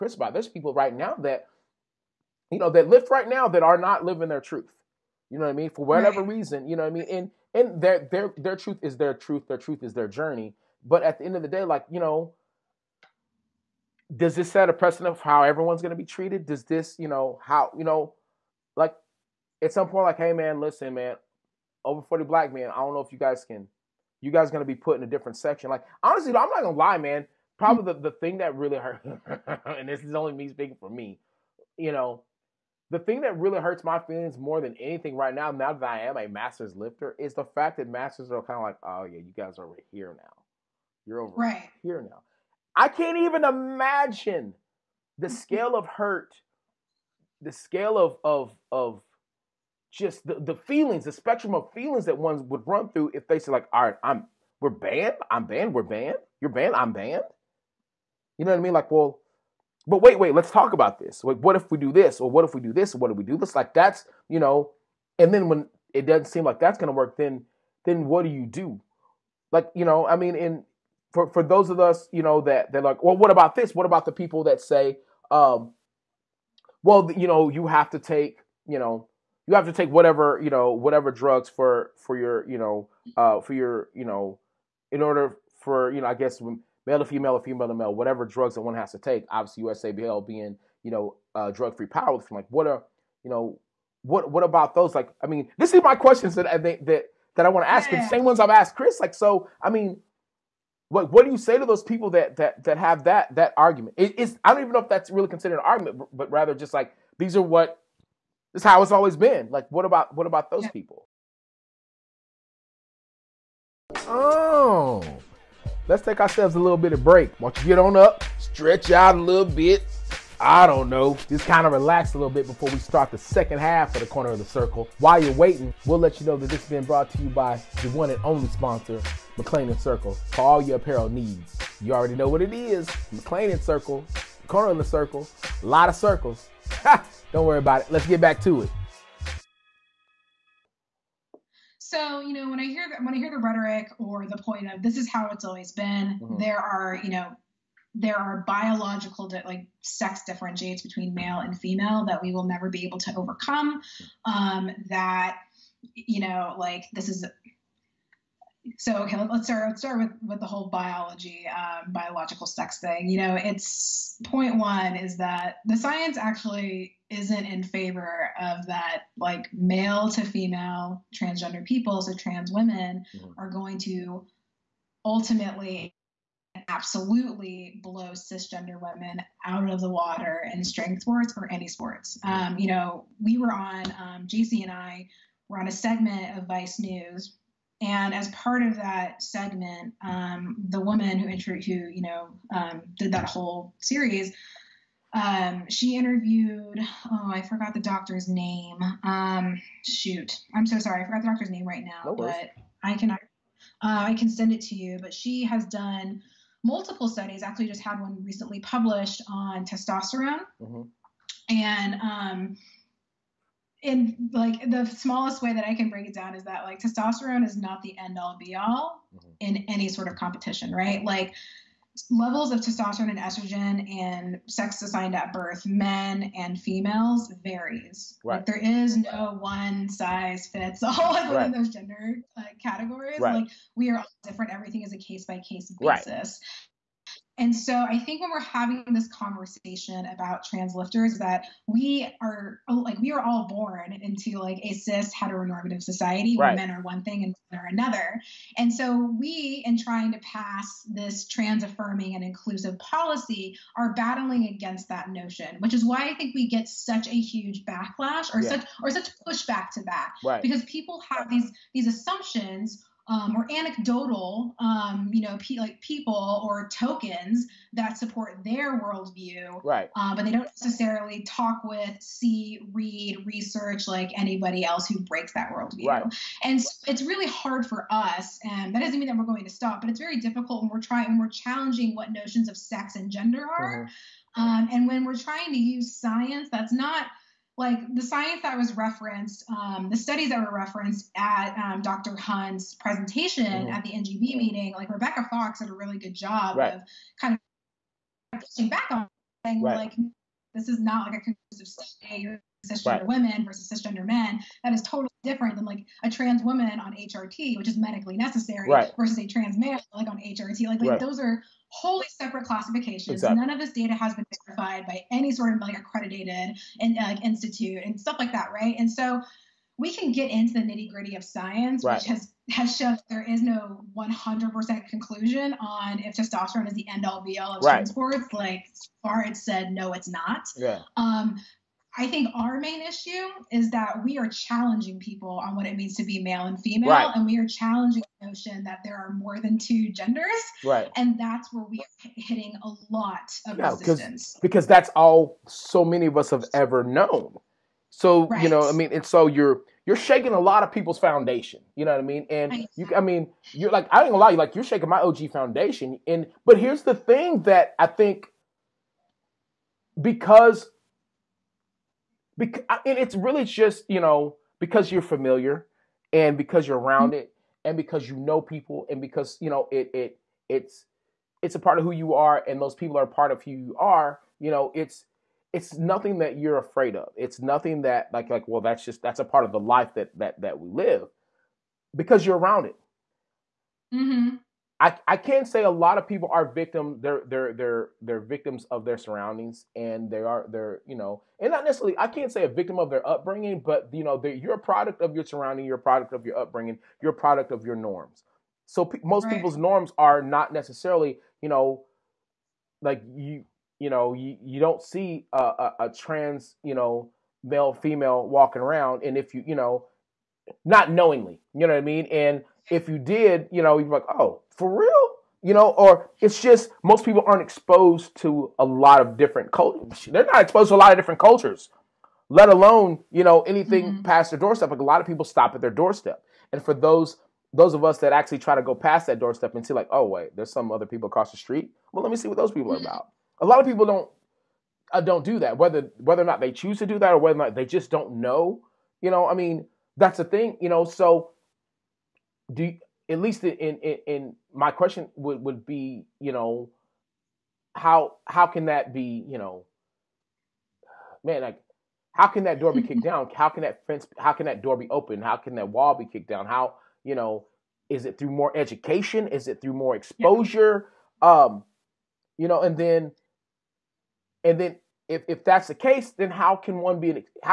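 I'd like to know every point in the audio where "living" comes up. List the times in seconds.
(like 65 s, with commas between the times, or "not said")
4 s.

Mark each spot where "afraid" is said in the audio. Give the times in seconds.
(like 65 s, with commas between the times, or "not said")
376 s.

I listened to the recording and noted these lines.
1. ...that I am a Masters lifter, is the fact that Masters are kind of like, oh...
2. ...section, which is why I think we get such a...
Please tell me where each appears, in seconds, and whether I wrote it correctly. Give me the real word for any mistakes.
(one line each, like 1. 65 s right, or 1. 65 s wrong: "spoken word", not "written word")
1. 35 s right
2. 255 s wrong: "notion", not "section".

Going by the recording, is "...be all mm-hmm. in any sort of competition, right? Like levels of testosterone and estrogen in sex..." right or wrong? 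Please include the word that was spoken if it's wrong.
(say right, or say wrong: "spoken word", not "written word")
right.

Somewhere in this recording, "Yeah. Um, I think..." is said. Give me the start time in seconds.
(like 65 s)
330 s.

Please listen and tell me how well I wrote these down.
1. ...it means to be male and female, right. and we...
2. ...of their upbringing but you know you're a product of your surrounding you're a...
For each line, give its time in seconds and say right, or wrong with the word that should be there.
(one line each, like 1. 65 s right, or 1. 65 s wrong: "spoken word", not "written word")
1. 335 s right
2. 392 s right.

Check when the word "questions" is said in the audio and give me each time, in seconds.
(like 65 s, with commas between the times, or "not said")
95 s, 444 s.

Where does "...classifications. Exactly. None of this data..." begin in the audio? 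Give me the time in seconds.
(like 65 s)
312 s.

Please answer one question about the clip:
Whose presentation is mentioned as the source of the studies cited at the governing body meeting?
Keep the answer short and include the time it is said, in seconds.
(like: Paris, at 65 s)
Dr. Hunt, at 291 s.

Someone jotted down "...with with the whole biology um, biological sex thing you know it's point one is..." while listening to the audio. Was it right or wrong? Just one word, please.
right.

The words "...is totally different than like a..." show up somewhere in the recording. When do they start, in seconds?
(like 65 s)
304 s.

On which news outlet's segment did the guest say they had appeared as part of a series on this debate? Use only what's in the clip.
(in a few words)
Vice News.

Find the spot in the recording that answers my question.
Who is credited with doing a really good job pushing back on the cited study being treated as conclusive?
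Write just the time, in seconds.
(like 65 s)
294 s.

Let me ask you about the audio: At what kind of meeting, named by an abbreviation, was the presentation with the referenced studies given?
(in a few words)
NGB meeting.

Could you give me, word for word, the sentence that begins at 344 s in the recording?
Because that's all so many of us have ever known.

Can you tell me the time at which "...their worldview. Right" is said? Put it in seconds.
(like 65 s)
268 s.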